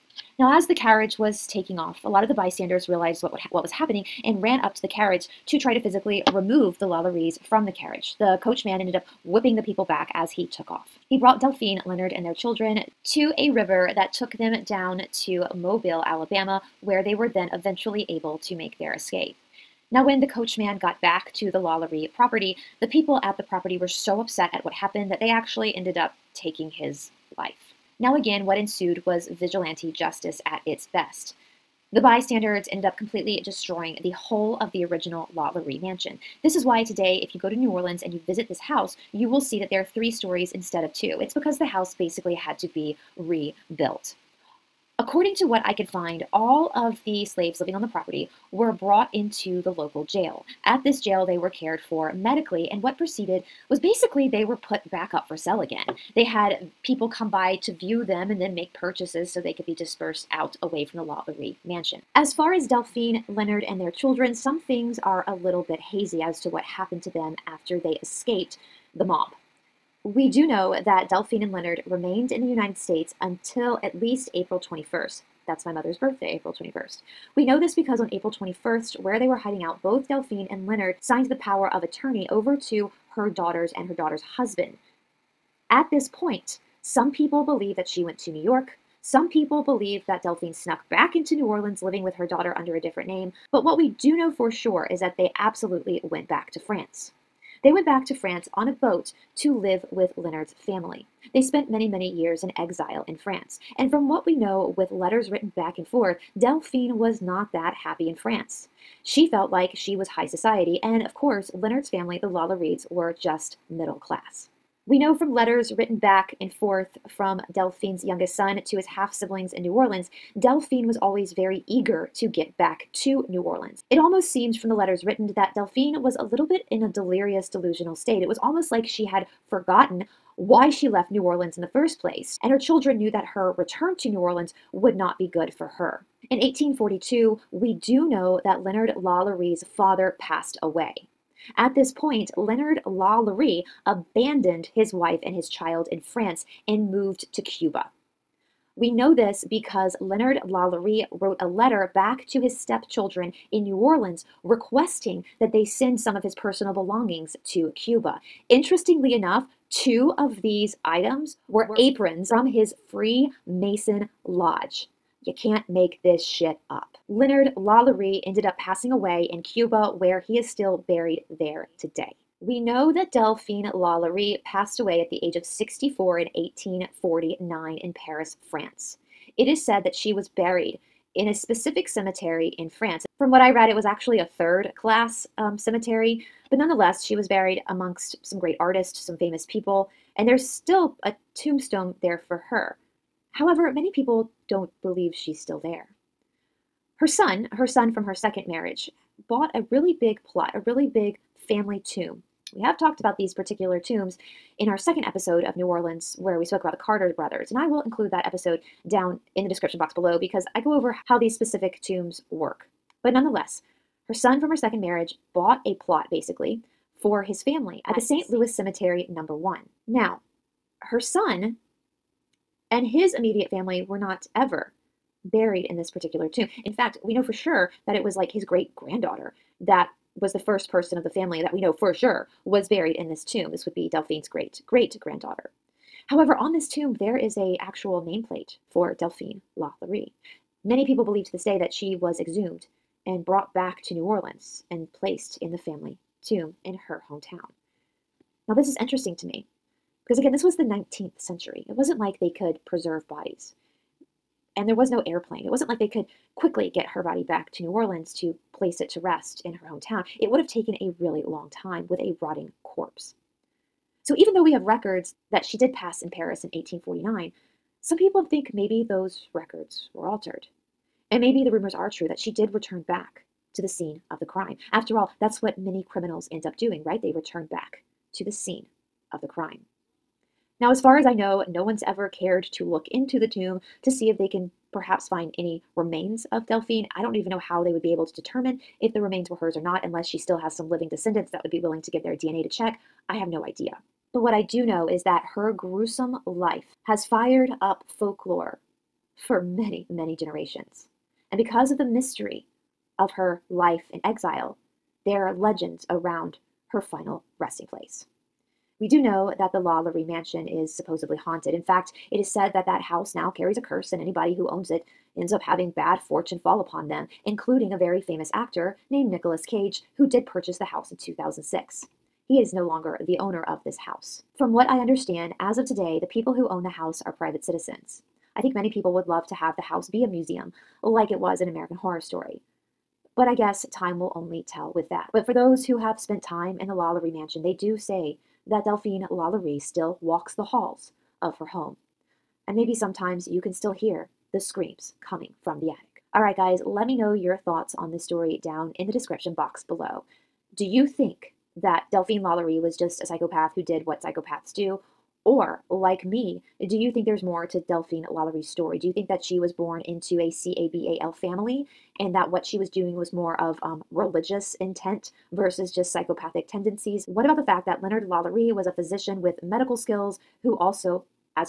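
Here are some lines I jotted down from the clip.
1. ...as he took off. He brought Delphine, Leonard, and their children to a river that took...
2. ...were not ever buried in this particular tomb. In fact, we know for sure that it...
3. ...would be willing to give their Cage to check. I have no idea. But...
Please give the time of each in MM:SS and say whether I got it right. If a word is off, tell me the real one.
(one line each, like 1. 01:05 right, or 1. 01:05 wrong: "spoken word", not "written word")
1. 00:10 right
2. 03:43 right
3. 04:51 wrong: "DNA", not "Cage".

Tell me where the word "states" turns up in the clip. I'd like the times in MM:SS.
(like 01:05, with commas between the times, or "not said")
01:12, 02:07.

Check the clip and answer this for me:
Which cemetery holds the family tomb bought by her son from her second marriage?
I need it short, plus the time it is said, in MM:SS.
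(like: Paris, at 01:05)
St. Louis Cemetery number 1, at 03:37.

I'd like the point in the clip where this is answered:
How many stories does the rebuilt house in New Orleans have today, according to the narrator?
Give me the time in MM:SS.
00:39.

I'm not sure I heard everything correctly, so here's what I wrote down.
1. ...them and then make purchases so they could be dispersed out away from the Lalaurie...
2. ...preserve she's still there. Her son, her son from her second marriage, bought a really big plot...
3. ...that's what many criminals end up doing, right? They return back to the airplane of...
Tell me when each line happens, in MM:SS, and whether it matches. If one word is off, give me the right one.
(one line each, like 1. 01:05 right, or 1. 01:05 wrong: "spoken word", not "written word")
1. 00:58 right
2. 03:14 wrong: "believe", not "preserve"
3. 04:35 wrong: "scene", not "airplane".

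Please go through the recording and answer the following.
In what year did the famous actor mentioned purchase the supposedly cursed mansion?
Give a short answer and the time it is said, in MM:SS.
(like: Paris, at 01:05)
2006, at 05:20.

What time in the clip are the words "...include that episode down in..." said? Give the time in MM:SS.
03:27.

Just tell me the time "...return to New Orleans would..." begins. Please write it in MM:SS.
02:13.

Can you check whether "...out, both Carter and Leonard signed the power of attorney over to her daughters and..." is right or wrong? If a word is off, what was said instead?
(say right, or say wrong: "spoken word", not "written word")
wrong: "Delphine", not "Carter".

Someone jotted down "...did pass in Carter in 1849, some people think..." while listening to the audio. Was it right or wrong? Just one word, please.
wrong.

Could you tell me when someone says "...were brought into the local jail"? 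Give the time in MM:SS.
00:48.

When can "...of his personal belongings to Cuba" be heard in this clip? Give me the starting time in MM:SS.
02:36.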